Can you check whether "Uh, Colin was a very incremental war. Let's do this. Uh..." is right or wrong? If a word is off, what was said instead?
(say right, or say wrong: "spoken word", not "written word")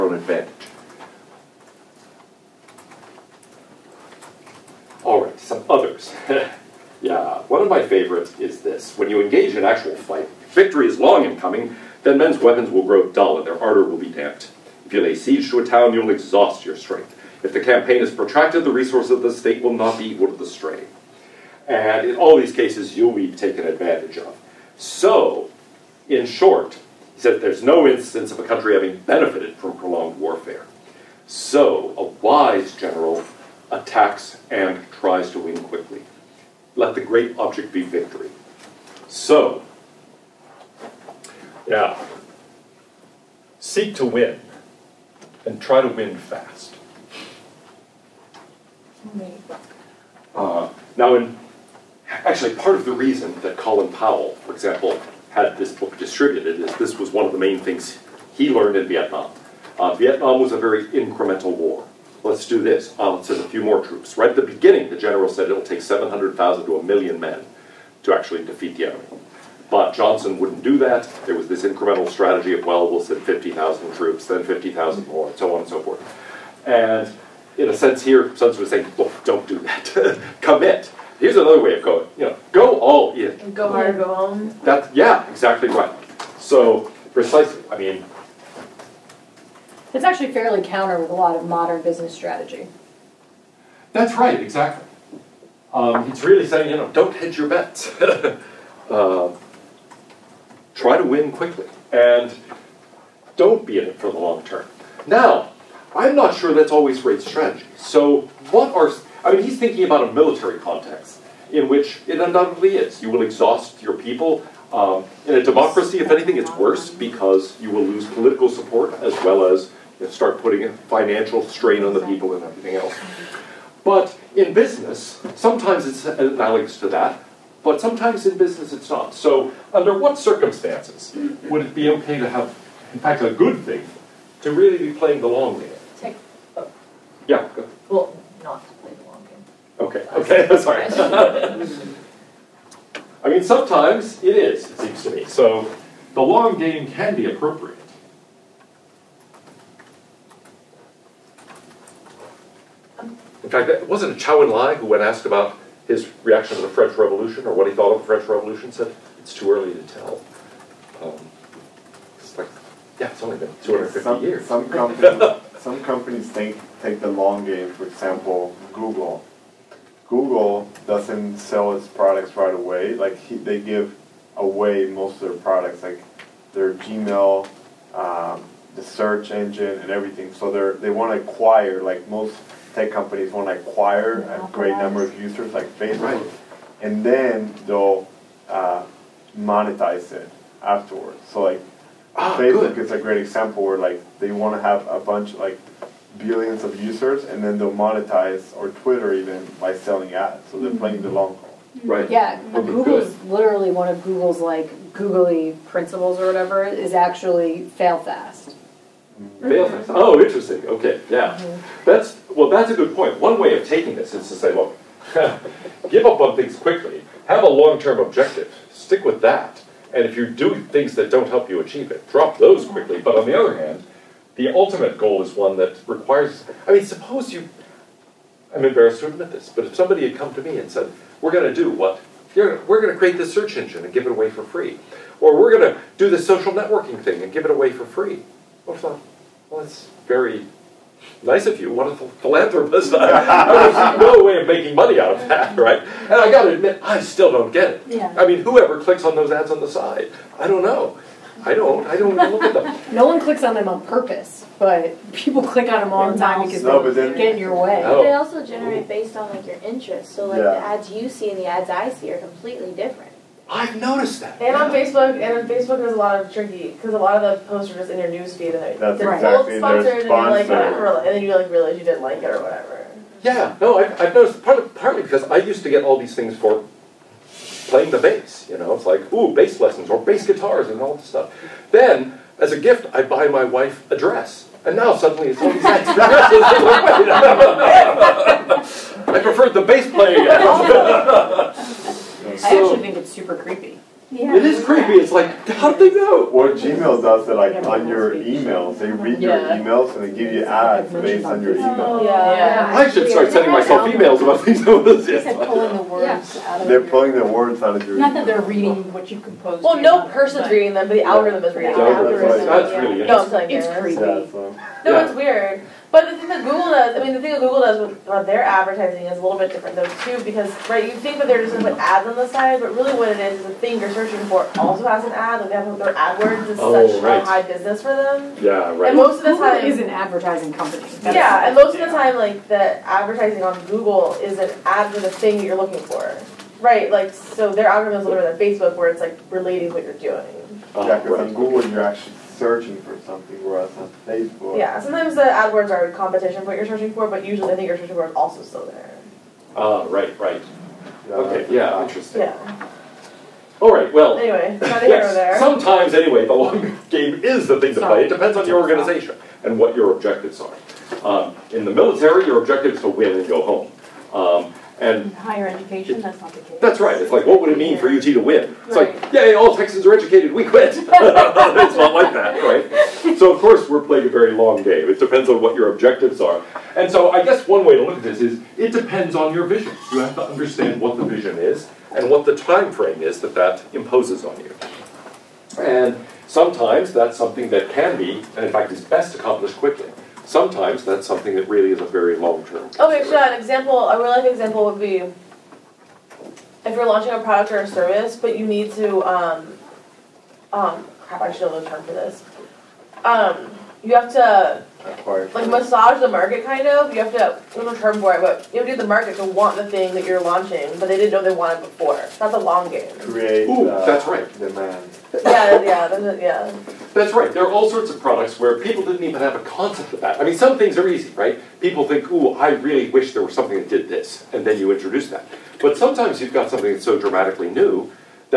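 wrong: "Vietnam", not "Colin".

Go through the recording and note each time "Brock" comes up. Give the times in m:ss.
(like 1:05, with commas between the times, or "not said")
not said.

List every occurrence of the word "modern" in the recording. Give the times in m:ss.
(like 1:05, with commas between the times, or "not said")
1:31.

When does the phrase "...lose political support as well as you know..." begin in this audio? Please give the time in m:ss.
1:57.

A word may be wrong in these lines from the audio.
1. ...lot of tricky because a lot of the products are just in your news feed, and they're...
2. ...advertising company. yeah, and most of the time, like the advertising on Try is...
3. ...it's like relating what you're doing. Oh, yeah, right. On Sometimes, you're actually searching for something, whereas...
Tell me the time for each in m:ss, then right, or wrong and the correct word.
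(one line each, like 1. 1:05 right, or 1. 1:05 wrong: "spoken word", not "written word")
1. 4:25 wrong: "posts", not "products"
2. 5:29 wrong: "Google", not "Try"
3. 5:38 wrong: "Google", not "Sometimes".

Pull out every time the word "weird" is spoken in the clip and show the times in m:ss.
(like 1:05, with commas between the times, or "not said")
5:15.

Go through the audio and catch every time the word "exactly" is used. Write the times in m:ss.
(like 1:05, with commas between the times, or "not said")
1:25, 1:34, 4:29.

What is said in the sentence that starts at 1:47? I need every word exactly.
So, what are, I mean, he's thinking about a military context in which it undoubtedly is.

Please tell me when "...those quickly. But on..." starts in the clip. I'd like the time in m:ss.
3:42.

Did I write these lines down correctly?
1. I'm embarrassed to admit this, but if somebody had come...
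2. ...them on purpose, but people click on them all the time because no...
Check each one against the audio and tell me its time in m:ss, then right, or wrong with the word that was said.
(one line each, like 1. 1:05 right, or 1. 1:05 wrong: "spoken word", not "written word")
1. 3:48 right
2. 4:13 right.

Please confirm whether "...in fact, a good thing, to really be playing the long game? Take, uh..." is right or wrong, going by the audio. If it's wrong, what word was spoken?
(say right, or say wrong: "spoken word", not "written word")
right.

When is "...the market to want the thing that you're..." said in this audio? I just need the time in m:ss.
6:48.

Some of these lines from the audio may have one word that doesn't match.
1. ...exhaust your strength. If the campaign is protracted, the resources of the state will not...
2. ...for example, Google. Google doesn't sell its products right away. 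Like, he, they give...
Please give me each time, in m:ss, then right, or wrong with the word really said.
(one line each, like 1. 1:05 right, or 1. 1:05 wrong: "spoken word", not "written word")
1. 0:16 right
2. 2:47 right.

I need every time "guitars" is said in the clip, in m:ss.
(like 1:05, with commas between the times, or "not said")
4:40.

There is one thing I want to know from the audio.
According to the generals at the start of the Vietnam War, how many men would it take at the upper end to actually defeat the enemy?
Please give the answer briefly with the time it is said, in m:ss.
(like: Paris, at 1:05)
1,000,000, at 1:06.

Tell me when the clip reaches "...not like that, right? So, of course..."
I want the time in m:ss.
6:11.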